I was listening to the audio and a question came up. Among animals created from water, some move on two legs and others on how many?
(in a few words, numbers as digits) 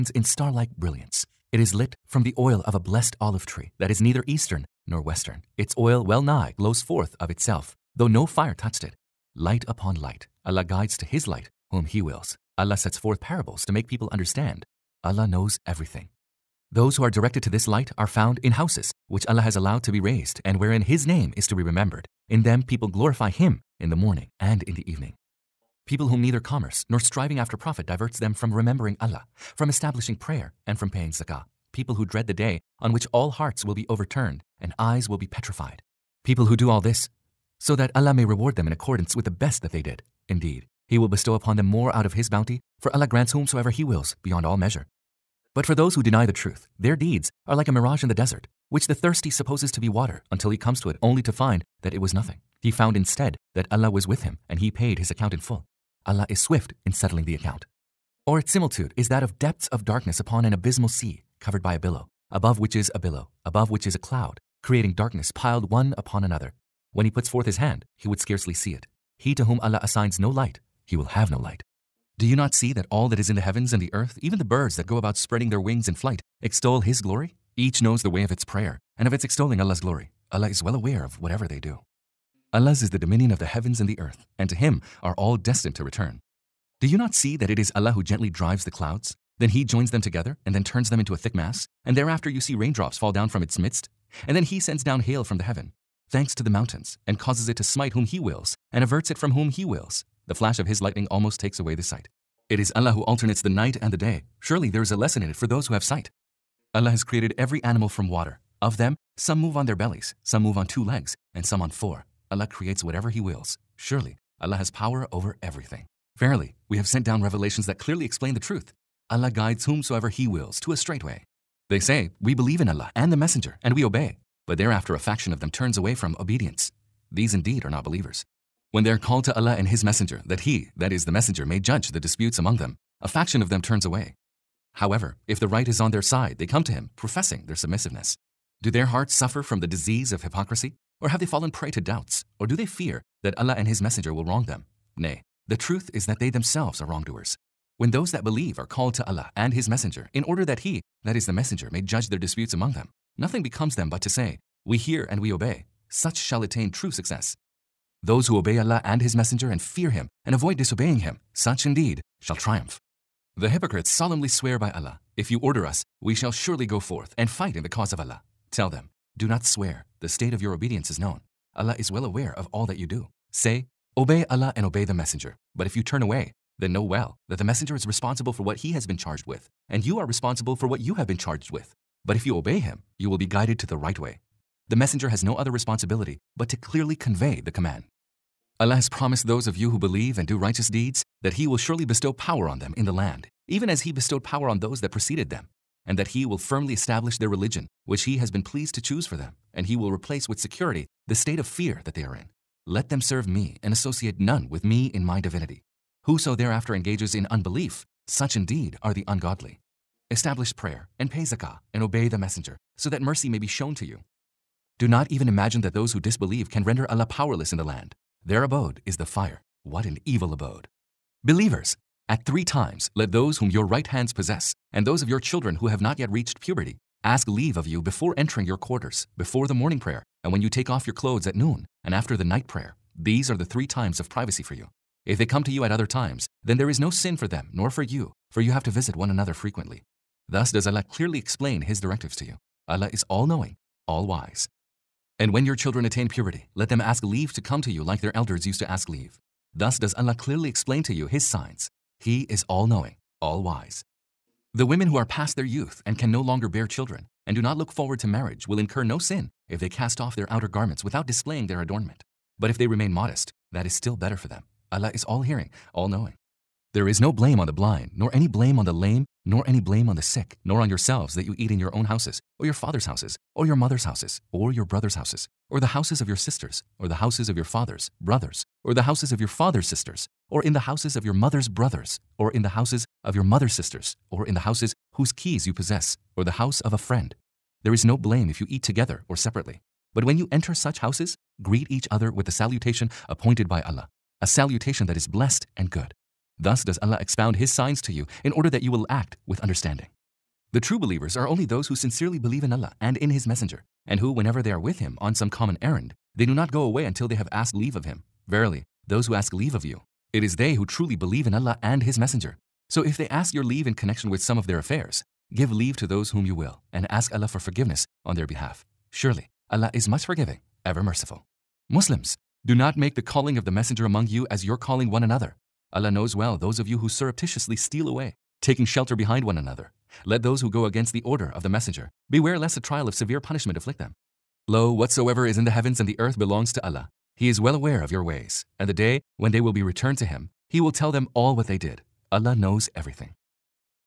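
4.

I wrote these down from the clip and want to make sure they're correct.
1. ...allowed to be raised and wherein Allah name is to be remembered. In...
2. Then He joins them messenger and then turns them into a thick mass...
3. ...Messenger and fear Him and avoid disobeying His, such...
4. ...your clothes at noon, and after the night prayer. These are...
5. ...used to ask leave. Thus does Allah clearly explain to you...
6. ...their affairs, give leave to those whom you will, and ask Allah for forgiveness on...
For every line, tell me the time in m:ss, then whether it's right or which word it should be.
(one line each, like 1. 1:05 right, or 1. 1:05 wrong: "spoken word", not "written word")
1. 0:19 wrong: "His", not "Allah"
2. 1:29 wrong: "together", not "messenger"
3. 2:39 wrong: "Him", not "His"
4. 3:50 right
5. 4:08 right
6. 5:14 right.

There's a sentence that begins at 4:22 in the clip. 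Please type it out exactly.
But if they remain modest, that is still better for them.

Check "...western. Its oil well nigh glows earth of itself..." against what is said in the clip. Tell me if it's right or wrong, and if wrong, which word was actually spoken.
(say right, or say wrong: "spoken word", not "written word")
wrong: "forth", not "earth".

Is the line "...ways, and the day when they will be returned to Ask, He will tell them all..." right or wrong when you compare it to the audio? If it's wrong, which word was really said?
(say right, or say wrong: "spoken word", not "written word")
wrong: "Him", not "Ask".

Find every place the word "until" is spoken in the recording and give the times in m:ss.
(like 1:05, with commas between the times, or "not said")
0:50, 5:06.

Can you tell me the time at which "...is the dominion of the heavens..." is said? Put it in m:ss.
1:22.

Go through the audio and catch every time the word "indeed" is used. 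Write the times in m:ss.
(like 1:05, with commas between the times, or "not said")
0:40, 2:07, 2:41, 3:28.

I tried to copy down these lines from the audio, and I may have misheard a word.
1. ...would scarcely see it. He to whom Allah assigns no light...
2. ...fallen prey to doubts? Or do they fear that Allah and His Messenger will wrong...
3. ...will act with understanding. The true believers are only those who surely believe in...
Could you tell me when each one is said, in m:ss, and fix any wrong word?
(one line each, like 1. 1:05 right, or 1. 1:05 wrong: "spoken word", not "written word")
1. 1:08 right
2. 2:21 right
3. 4:58 wrong: "sincerely", not "surely".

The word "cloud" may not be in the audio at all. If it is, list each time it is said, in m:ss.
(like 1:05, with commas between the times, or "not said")
1:03, 1:28.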